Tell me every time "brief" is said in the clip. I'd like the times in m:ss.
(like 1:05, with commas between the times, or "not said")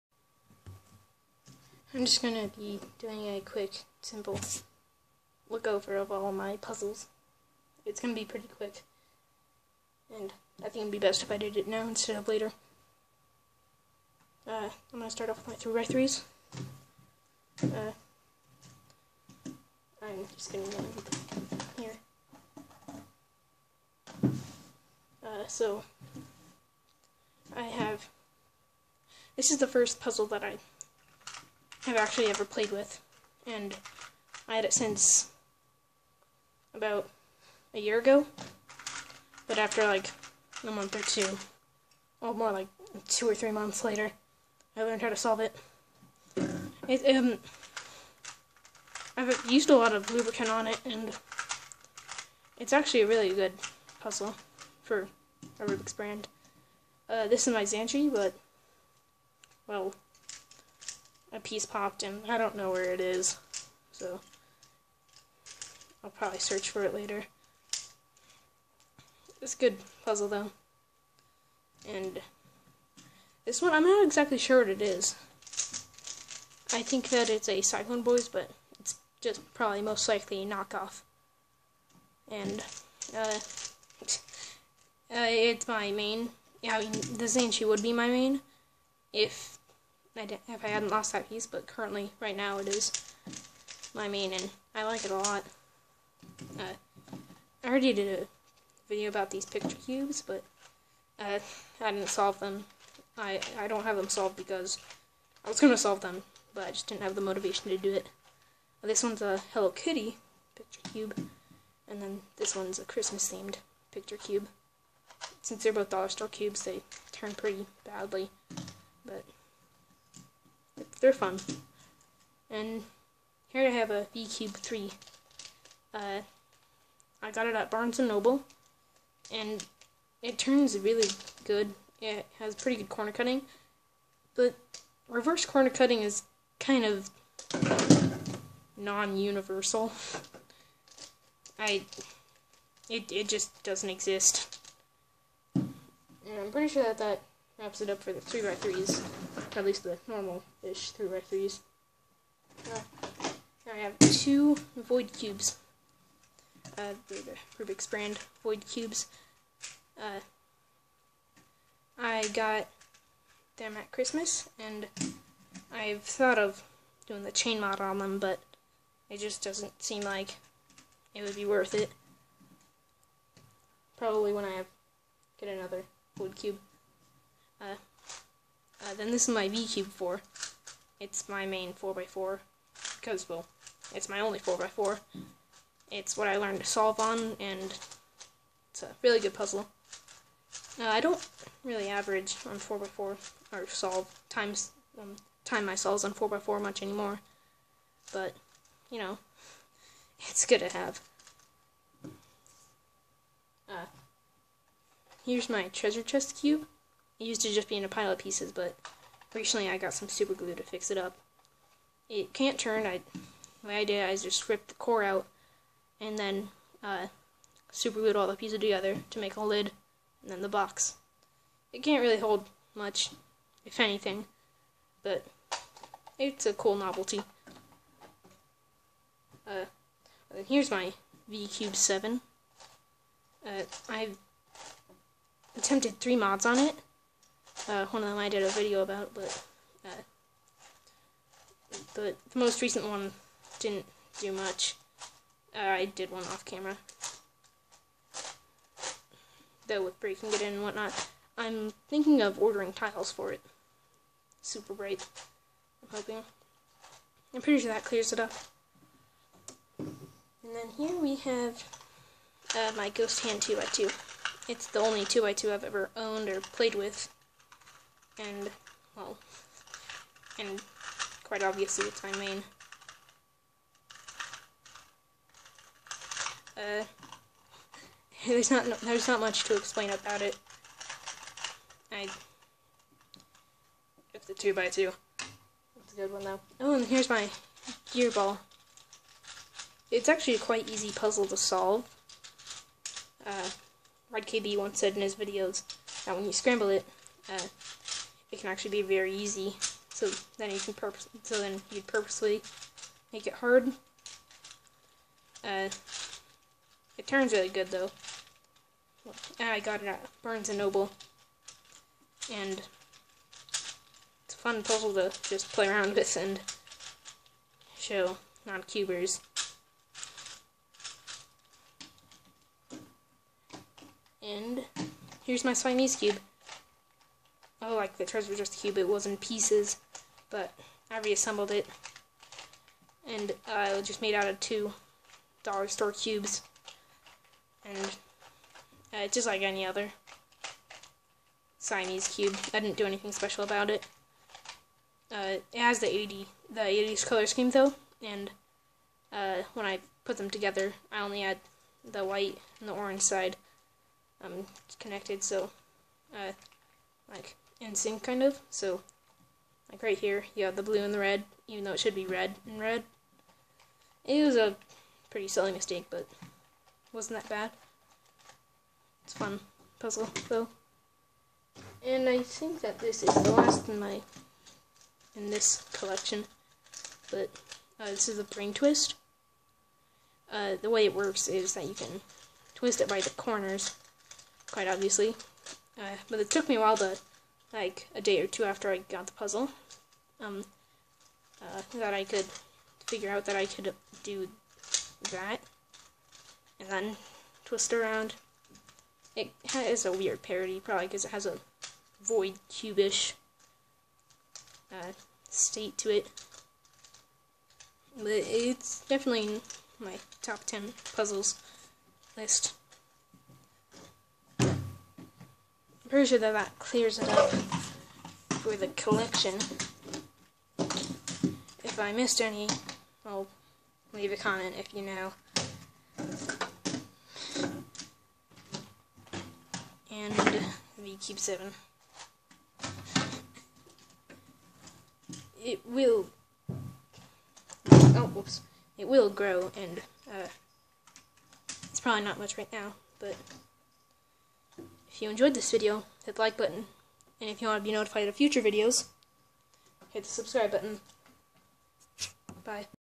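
not said.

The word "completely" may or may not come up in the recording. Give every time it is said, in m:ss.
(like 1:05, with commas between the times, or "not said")
not said.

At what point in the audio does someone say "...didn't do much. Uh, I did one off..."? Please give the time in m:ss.
4:03.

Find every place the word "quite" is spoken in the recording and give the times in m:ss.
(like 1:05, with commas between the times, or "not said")
4:31, 4:50, 6:24.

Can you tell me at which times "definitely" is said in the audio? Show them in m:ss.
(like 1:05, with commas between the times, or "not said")
6:48.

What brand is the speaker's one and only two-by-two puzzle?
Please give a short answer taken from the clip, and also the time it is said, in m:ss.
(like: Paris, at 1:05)
Ghost Hand, at 4:22.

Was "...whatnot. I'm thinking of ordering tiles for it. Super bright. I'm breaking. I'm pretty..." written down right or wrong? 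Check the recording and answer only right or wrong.
wrong.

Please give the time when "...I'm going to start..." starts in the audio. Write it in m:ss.
0:14.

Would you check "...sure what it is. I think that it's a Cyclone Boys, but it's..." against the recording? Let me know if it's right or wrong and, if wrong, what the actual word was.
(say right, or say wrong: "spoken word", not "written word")
right.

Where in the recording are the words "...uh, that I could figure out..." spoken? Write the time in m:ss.
6:31.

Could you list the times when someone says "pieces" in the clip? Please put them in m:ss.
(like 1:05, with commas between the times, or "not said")
1:01, 1:31, 3:28, 3:38, 5:29.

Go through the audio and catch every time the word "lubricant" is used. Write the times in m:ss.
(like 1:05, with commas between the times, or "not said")
0:50.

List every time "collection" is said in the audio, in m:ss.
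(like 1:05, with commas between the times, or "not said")
6:15, 6:58.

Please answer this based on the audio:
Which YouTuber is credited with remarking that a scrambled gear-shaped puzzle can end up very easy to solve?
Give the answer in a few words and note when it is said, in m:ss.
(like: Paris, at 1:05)
Red KB, at 4:54.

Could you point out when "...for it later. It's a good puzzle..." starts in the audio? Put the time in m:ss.
1:06.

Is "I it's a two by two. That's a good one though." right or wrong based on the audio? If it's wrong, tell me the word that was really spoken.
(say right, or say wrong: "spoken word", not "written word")
right.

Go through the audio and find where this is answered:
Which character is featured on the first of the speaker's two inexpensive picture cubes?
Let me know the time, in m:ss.
1:49.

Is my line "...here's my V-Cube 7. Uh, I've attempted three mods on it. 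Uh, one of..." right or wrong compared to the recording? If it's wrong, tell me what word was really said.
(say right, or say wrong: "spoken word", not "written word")
right.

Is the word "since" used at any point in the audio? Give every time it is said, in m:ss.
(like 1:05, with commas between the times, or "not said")
0:34, 1:55.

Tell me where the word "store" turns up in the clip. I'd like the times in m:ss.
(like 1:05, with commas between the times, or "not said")
1:56, 5:35.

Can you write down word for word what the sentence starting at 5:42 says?
I didn't do anything special about it.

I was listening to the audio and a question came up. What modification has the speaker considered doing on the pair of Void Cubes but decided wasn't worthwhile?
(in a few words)
the chain mod.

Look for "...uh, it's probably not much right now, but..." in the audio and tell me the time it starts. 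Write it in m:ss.
7:20.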